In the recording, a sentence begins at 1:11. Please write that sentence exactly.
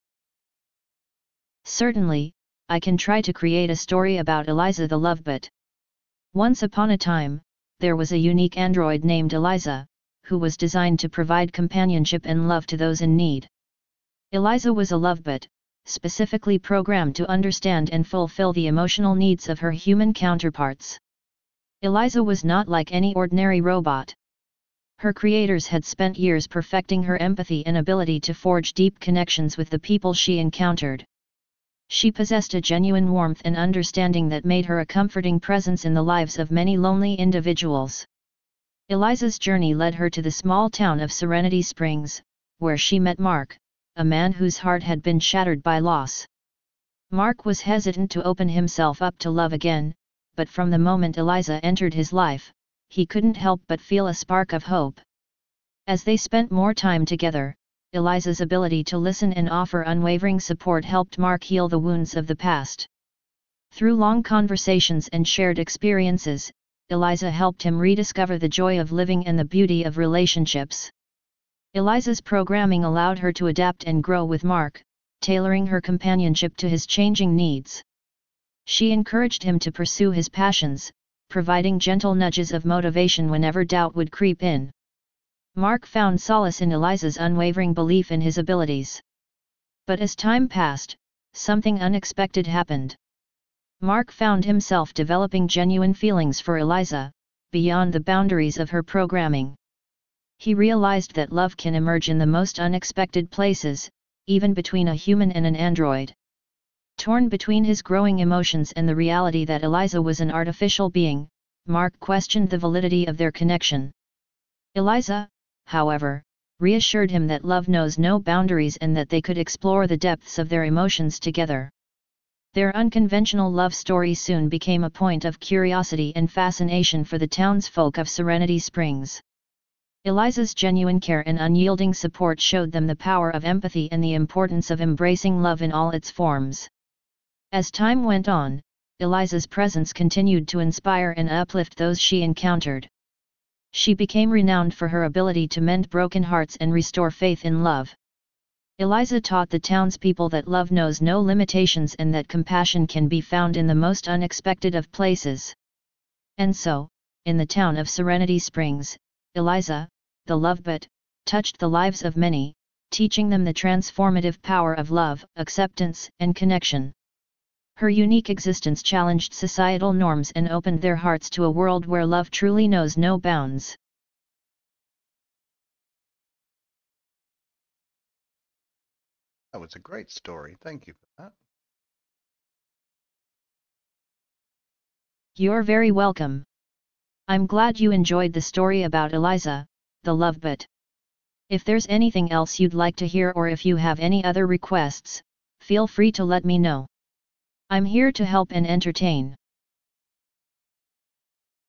Eliza's programming allowed her to adapt and grow with Mark, tailoring her companionship to his changing needs.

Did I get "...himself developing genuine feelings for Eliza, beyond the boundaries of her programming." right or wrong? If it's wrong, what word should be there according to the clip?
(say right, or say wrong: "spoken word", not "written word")
right.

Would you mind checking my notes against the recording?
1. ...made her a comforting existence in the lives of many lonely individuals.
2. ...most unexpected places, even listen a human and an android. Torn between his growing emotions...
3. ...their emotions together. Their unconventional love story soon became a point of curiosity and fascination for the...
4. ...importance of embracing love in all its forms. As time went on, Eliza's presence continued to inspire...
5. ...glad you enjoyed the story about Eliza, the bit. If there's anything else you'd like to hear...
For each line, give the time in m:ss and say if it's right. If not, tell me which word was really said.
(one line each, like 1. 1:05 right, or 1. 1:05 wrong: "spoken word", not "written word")
1. 0:34 wrong: "presence", not "existence"
2. 1:42 wrong: "between", not "listen"
3. 2:00 right
4. 2:14 right
5. 3:07 right.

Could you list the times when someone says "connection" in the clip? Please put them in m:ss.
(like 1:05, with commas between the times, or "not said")
0:28, 1:53, 2:46.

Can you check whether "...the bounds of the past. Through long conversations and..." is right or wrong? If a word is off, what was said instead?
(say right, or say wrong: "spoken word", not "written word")
wrong: "wounds", not "bounds".